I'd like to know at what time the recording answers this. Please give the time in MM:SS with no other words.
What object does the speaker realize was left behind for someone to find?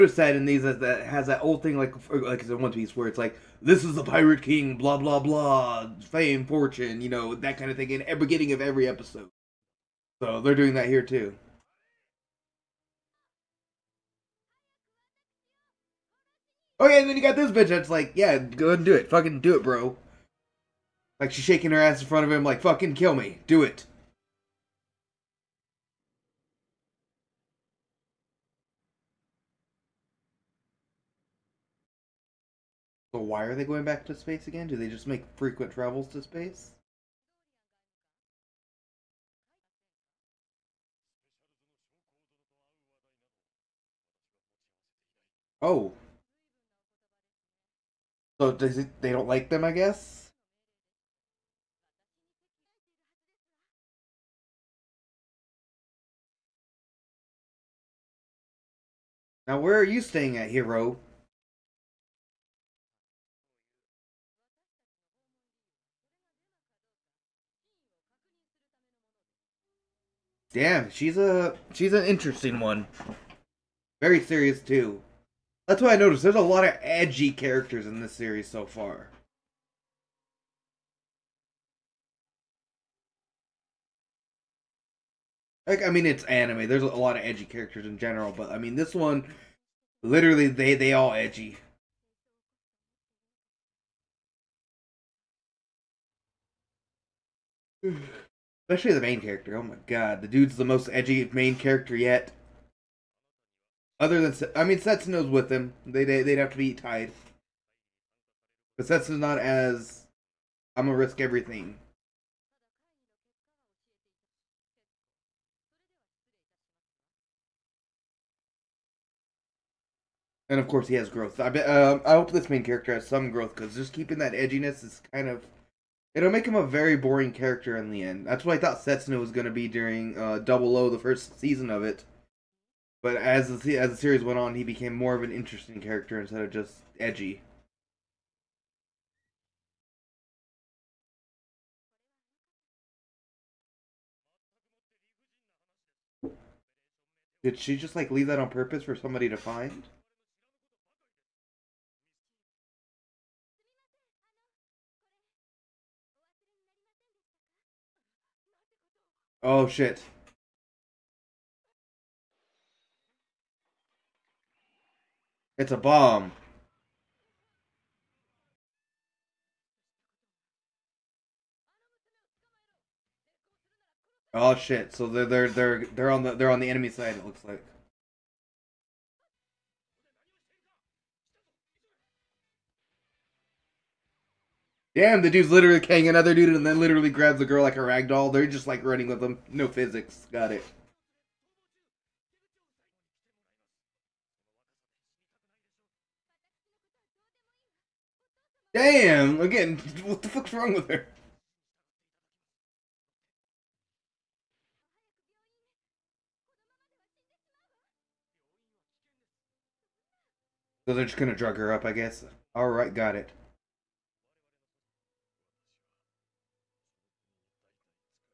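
02:45.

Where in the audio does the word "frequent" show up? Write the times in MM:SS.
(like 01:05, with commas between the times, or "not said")
00:35.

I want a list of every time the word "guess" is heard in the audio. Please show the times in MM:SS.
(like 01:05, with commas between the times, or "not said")
00:49, 03:31.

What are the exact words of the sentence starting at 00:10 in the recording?
So they're doing that here too.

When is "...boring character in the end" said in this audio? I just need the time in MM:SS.
02:06.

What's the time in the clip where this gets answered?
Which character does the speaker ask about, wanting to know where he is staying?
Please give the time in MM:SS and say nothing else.
01:00.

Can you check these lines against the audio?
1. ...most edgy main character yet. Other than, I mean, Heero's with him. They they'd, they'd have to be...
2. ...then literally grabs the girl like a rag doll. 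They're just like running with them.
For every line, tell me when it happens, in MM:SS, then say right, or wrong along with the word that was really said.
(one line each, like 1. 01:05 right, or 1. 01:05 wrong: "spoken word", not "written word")
1. 01:40 wrong: "Setsuna", not "Heero"
2. 03:06 right.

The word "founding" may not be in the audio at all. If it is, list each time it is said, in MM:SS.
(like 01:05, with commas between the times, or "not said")
not said.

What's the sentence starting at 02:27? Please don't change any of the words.
Did she just like leave that on purpose for somebody to find?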